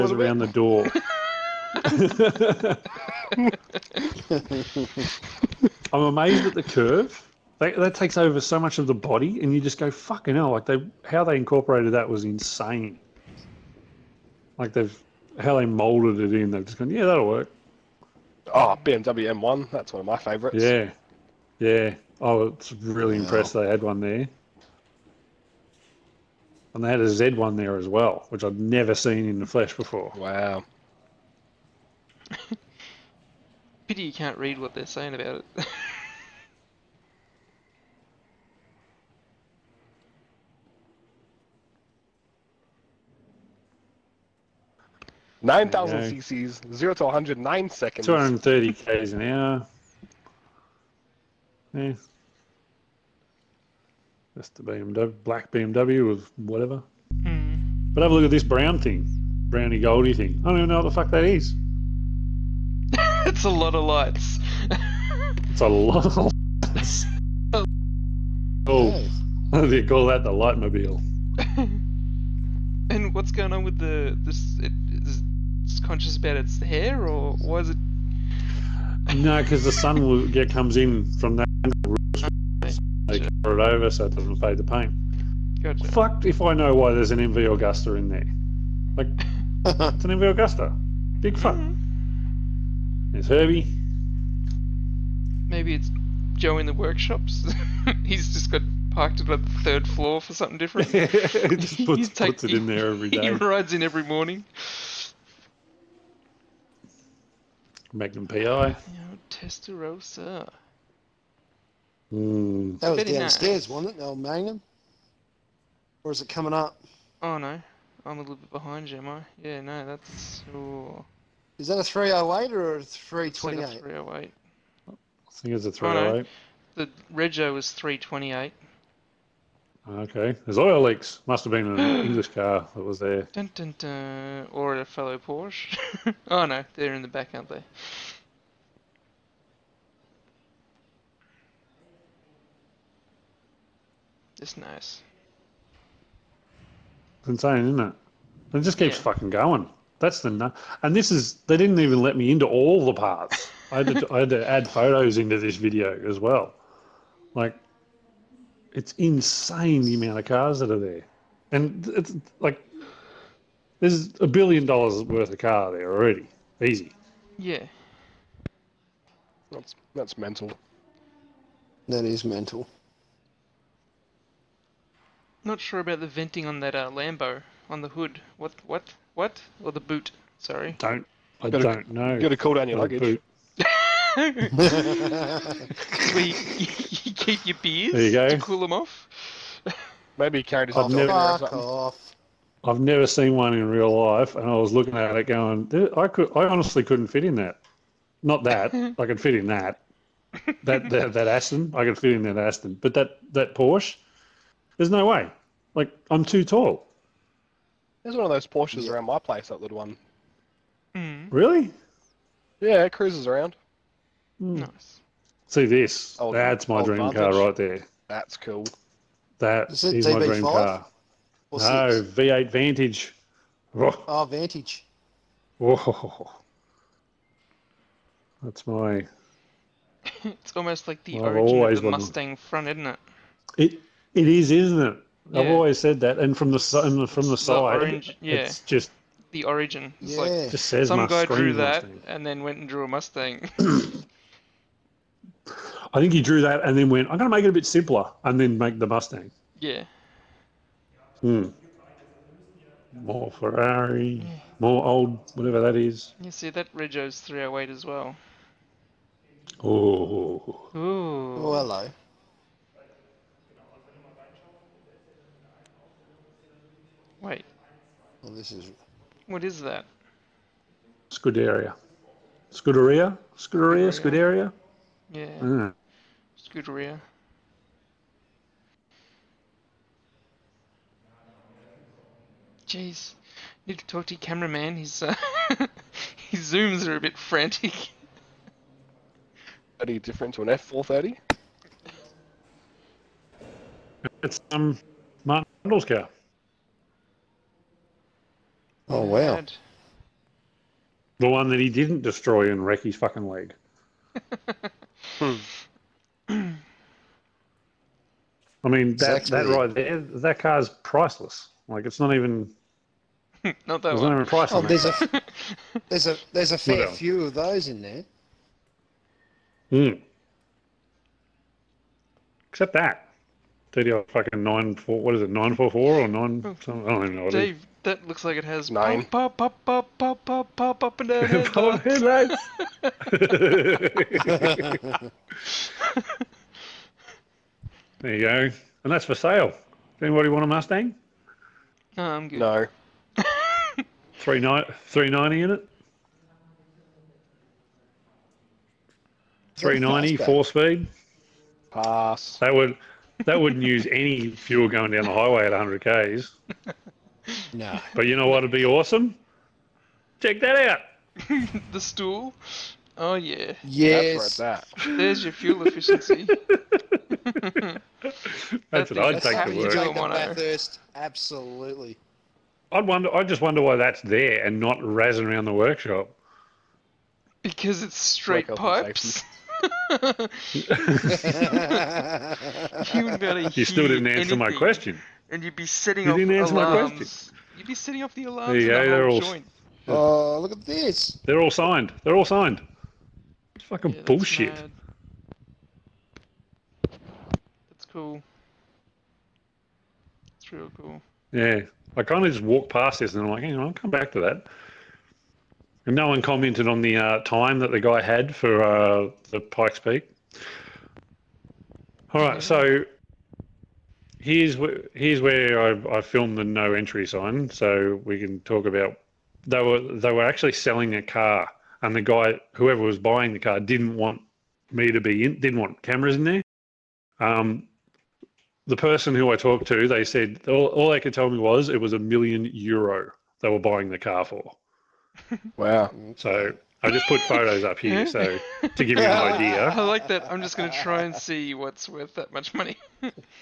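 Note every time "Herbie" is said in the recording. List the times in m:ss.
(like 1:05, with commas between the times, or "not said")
1:33.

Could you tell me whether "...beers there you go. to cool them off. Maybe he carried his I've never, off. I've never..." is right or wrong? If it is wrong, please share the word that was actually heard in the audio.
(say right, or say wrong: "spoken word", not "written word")
right.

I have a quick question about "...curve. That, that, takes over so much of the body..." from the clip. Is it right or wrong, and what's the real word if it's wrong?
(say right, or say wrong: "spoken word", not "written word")
right.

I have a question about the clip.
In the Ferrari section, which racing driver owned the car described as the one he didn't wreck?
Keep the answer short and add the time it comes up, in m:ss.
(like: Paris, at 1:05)
Martin Brundle, at 4:55.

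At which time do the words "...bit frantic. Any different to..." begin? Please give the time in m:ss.
4:46.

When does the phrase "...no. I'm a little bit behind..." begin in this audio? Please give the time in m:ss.
1:57.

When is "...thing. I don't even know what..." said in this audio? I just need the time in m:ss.
1:00.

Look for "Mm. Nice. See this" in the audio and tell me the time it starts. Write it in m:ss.
3:34.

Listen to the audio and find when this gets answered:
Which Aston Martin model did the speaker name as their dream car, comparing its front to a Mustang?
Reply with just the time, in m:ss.
3:42.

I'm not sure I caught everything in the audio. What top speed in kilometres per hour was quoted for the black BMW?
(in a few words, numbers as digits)
230 km/h.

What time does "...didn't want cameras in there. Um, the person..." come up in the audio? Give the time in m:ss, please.
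7:05.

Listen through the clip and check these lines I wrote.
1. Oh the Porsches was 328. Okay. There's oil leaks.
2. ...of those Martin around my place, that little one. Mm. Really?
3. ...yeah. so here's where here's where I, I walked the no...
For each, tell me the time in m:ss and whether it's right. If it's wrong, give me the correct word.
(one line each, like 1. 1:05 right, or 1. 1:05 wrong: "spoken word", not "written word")
1. 2:06 wrong: "Rego", not "Porsches"
2. 3:28 wrong: "Porsches", not "Martin"
3. 6:52 wrong: "filmed", not "walked".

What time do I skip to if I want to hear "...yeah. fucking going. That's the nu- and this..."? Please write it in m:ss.
2:28.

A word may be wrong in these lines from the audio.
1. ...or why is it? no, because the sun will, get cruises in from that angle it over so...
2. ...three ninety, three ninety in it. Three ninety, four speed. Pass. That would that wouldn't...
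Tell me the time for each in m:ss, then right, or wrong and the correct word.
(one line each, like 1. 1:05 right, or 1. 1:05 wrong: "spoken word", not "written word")
1. 1:17 wrong: "comes", not "cruises"
2. 5:44 right.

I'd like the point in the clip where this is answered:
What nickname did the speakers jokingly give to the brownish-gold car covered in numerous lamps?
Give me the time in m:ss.
1:10.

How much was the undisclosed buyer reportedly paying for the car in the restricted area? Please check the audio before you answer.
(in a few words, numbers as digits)
1 million euro.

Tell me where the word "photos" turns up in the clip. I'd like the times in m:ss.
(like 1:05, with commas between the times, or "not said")
2:34, 7:17.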